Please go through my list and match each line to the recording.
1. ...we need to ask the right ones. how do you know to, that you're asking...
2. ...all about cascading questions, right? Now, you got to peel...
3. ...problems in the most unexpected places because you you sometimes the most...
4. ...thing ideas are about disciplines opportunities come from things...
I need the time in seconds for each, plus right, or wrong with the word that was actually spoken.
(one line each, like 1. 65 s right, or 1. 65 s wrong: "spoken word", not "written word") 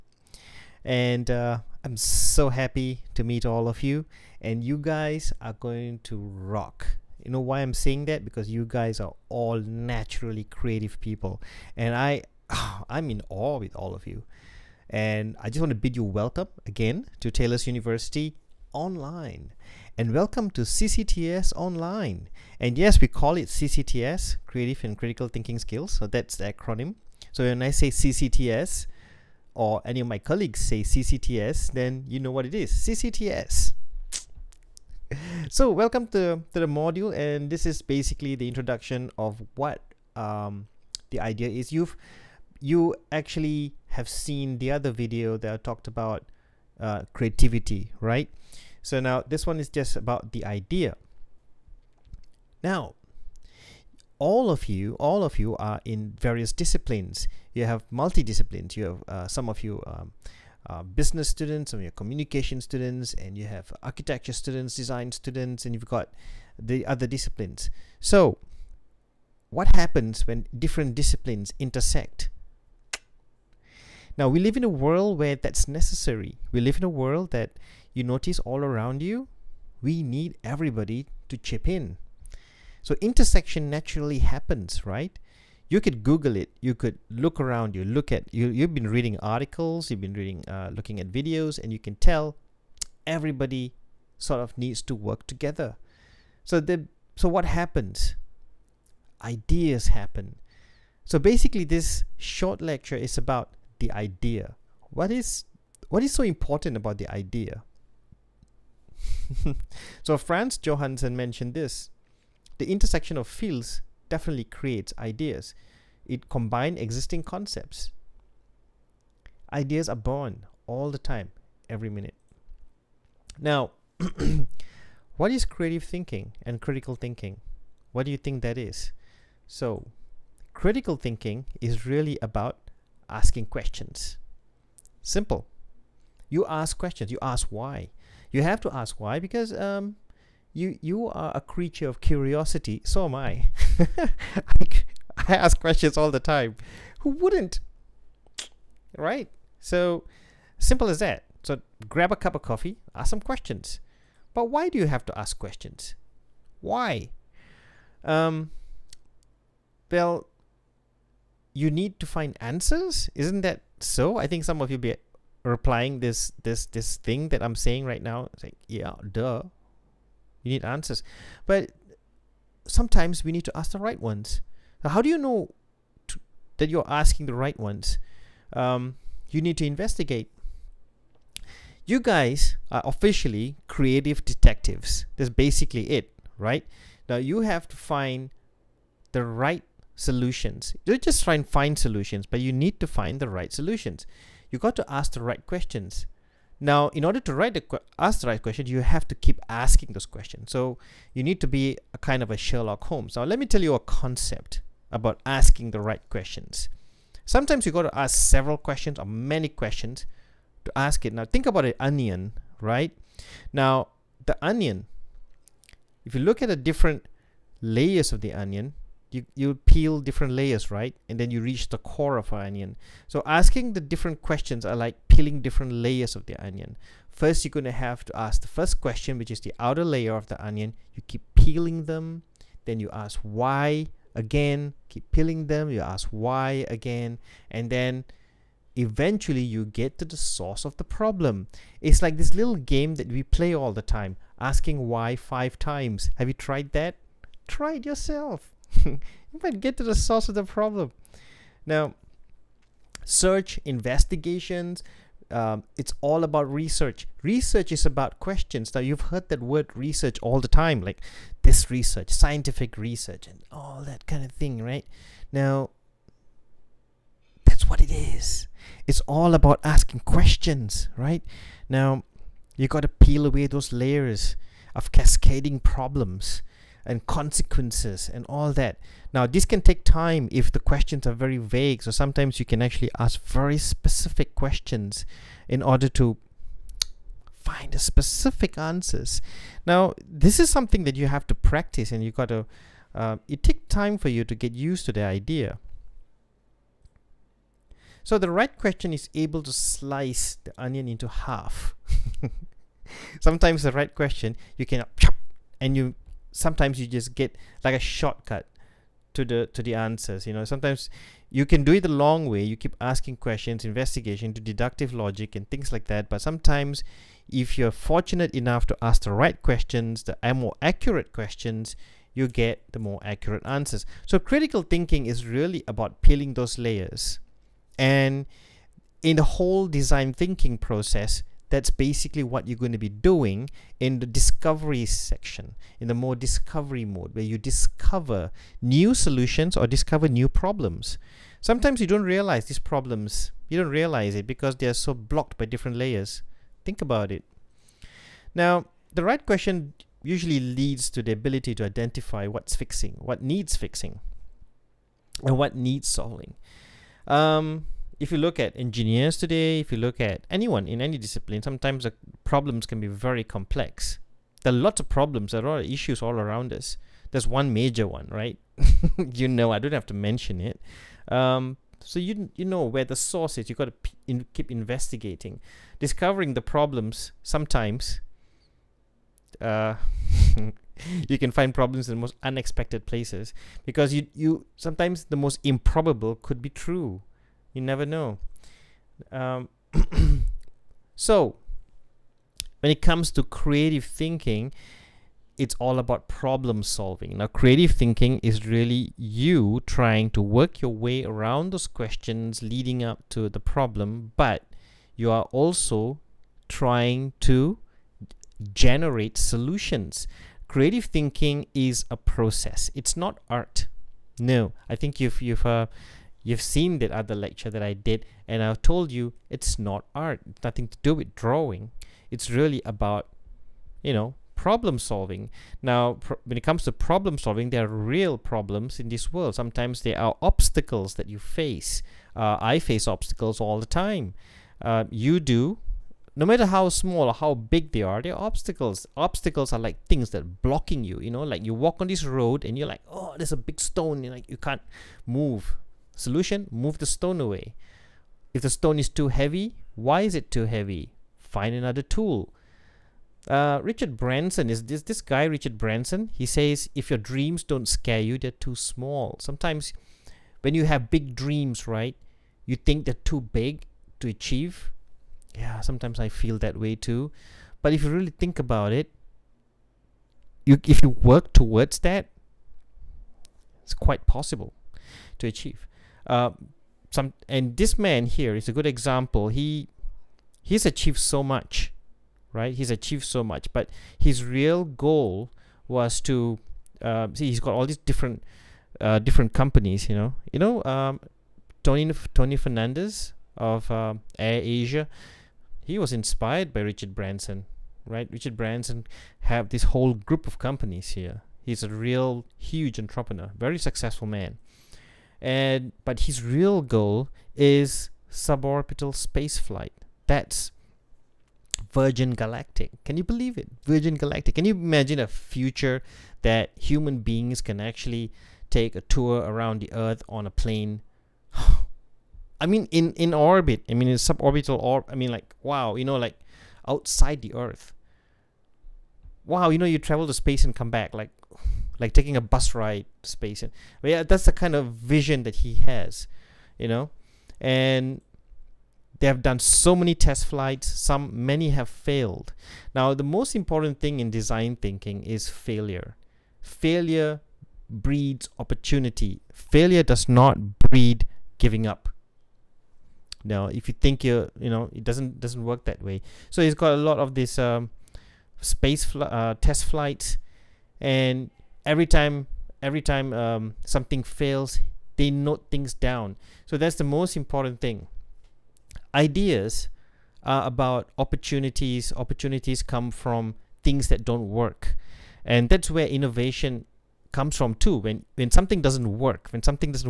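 1. 173 s right
2. 269 s wrong: "asking", not "cascading"
3. 381 s right
4. 567 s wrong: "opportunities", not "disciplines".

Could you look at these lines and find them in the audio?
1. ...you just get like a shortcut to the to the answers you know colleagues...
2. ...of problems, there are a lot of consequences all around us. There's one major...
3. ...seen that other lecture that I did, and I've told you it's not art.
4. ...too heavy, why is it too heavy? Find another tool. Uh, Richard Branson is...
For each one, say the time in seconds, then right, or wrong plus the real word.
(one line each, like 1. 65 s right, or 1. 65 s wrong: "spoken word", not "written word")
1. 306 s wrong: "sometimes", not "colleagues"
2. 364 s wrong: "issues", not "consequences"
3. 416 s right
4. 448 s right.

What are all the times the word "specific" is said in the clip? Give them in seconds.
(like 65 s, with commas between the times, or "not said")
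283 s, 287 s.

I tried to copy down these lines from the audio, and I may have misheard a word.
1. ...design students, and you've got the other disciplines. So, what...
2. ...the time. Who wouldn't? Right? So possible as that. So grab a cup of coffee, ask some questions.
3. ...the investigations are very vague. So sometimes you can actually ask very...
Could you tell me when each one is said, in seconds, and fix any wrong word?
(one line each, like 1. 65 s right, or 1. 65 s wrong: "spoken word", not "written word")
1. 64 s right
2. 146 s wrong: "simple", not "possible"
3. 280 s wrong: "questions", not "investigations".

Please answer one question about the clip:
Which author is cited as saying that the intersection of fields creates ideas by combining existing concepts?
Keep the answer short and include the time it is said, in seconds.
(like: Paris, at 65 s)
Franz Johansson, at 110 s.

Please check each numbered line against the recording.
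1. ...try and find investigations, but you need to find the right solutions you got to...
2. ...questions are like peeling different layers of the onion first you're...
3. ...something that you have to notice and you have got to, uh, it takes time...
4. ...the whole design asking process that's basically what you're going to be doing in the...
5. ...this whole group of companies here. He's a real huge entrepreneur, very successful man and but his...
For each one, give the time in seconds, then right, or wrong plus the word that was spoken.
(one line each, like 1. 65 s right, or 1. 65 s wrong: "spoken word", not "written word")
1. 191 s wrong: "solutions", not "investigations"
2. 224 s right
3. 290 s wrong: "practice", not "notice"
4. 329 s wrong: "thinking", not "asking"
5. 499 s right.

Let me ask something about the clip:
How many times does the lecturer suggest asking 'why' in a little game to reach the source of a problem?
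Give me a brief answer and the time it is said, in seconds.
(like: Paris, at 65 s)
5, at 245 s.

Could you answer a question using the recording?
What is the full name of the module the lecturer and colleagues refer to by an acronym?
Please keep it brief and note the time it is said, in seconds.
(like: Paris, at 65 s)
Creative and Critical Thinking Skills, at 24 s.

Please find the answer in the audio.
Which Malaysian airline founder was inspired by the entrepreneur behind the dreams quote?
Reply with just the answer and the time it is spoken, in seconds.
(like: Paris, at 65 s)
Tony Fernandez, at 492 s.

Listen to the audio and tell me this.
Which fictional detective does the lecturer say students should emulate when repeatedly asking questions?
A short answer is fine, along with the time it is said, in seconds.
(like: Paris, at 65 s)
Sherlock Holmes, at 202 s.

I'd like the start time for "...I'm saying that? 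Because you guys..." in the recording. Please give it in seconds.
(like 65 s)
7 s.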